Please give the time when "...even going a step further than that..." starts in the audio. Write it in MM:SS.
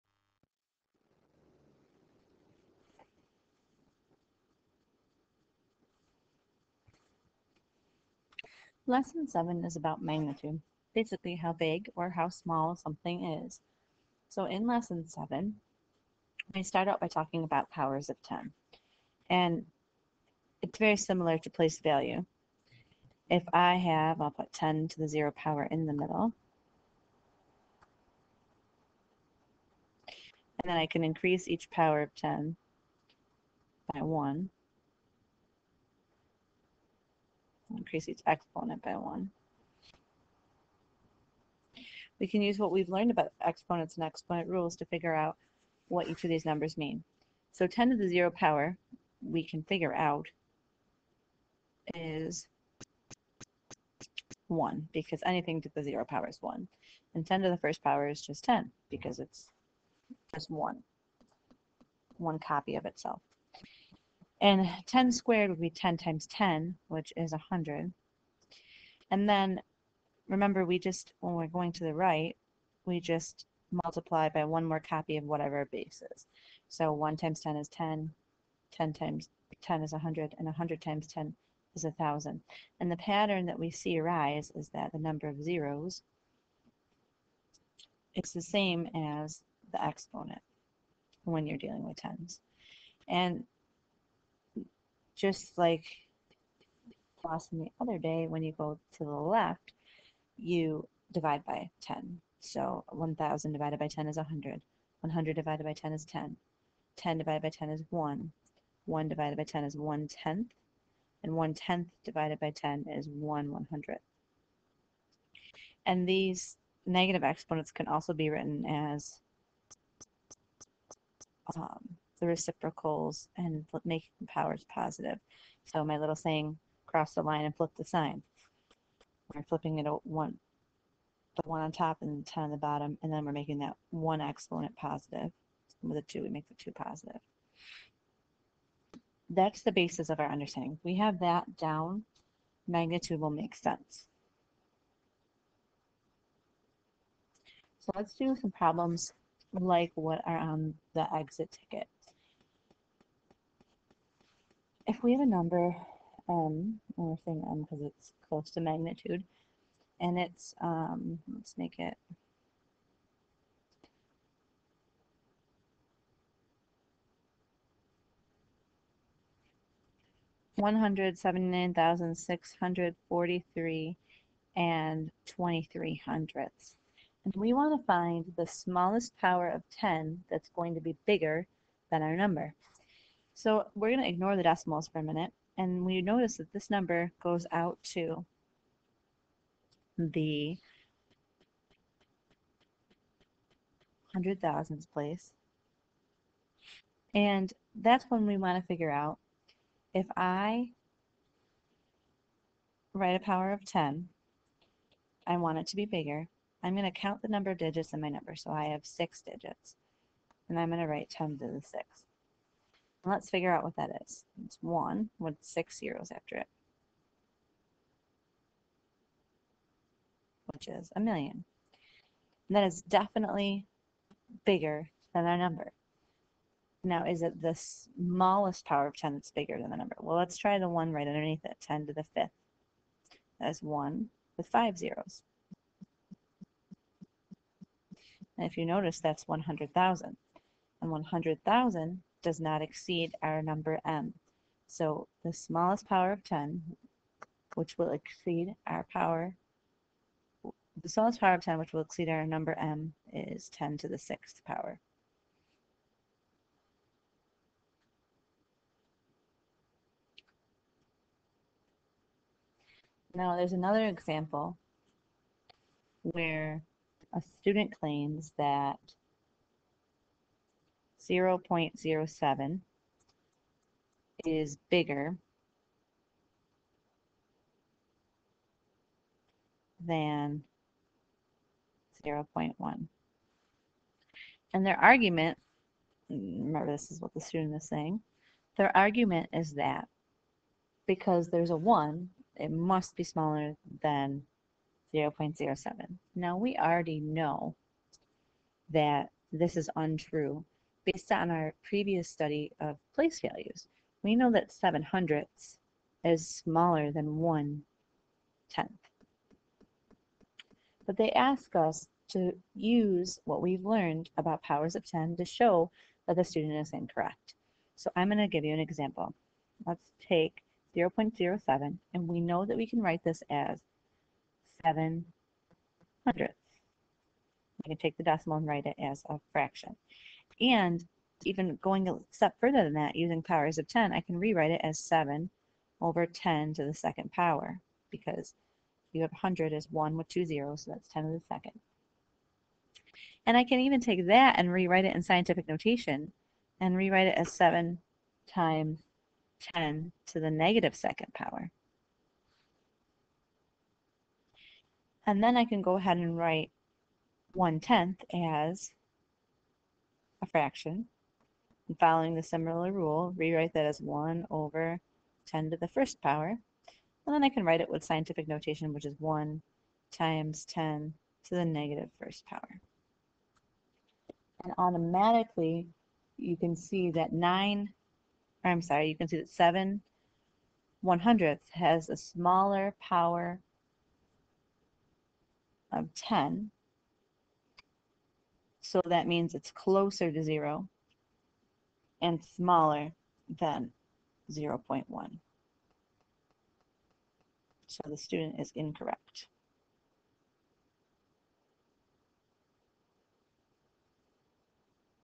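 05:31.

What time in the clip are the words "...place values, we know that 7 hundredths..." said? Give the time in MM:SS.
05:02.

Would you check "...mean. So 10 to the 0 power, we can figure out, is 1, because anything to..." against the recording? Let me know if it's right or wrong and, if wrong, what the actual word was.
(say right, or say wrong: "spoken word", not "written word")
right.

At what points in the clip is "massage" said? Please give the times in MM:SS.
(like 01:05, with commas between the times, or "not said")
not said.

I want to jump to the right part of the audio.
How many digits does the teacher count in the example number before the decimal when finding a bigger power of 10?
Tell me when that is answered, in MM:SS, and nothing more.
03:28.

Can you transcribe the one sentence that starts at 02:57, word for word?
And we want to find the smallest power of 10 that's going to be bigger than our number.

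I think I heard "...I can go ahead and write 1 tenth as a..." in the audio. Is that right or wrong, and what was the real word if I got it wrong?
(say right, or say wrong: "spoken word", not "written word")
right.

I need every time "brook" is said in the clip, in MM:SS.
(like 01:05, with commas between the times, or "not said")
not said.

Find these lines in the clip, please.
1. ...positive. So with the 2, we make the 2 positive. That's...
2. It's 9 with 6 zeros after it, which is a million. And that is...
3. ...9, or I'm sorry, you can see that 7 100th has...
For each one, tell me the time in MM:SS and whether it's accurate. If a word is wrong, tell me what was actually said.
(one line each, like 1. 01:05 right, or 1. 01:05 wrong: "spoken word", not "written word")
1. 02:14 right
2. 03:34 wrong: "1", not "9"
3. 06:17 right.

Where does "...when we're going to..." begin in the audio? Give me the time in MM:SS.
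01:11.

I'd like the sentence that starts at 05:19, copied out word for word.
Let's take 0.07, and we know that we can write this as 7 hundredths.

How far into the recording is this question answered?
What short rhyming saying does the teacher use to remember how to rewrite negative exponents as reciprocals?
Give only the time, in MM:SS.
02:06.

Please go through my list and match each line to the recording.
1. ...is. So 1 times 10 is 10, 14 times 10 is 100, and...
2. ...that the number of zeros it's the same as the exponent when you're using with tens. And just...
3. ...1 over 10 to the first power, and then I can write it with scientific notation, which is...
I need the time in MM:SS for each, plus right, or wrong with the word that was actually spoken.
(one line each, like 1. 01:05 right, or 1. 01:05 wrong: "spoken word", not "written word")
1. 01:16 wrong: "10", not "14"
2. 01:24 wrong: "dealing", not "using"
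3. 06:03 right.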